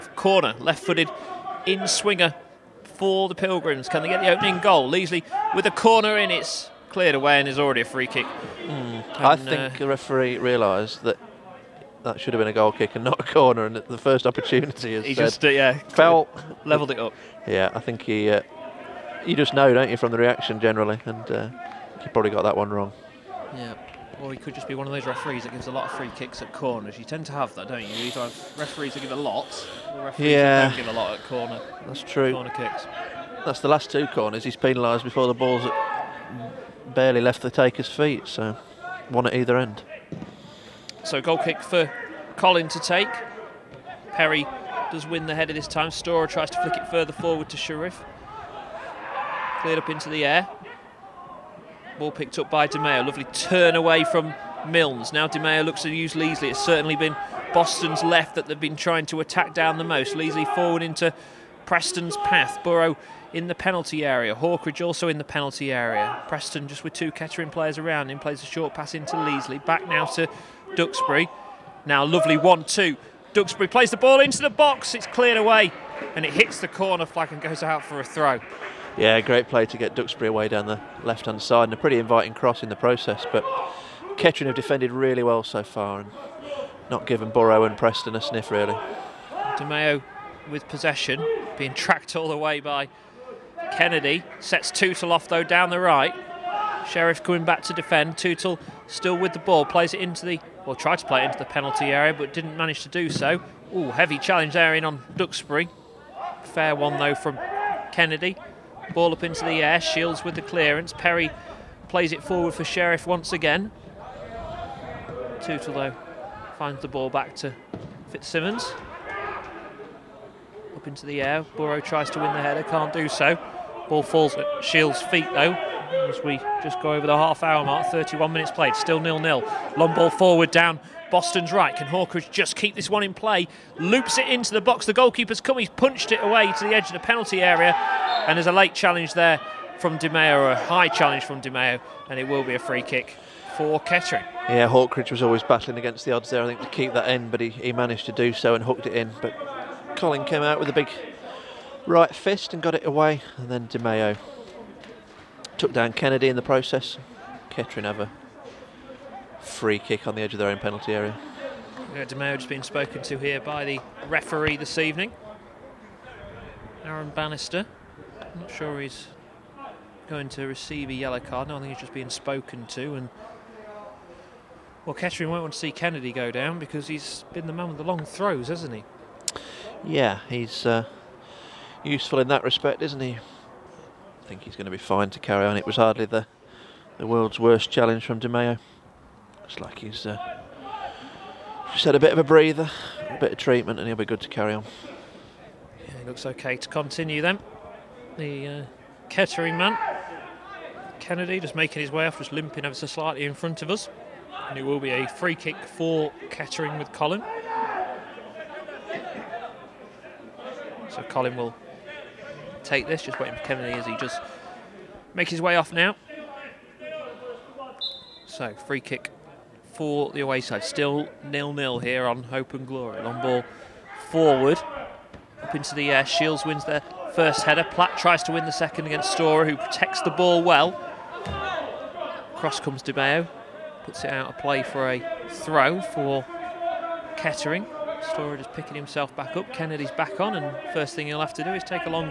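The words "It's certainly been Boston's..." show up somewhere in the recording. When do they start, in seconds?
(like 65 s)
56 s.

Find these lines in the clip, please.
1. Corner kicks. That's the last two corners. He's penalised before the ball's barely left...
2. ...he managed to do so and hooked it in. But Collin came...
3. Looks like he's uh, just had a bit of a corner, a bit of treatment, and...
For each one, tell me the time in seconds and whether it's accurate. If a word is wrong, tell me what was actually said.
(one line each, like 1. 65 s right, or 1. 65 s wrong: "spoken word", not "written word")
1. 32 s right
2. 147 s right
3. 189 s wrong: "breather", not "corner".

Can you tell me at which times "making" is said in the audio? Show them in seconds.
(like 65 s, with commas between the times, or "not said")
201 s.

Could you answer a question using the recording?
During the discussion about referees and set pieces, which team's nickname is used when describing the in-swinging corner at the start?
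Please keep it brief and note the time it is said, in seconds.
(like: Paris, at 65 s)
Pilgrims, at 3 s.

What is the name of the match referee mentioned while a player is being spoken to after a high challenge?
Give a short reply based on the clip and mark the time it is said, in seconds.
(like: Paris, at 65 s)
Aaron Bannister, at 166 s.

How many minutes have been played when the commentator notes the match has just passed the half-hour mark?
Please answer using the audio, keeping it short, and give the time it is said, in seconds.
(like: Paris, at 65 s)
31, at 127 s.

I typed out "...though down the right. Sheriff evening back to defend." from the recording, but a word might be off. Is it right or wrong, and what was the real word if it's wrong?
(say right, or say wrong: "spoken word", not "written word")
wrong: "coming", not "evening".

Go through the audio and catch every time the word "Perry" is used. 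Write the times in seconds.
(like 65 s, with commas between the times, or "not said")
44 s, 110 s.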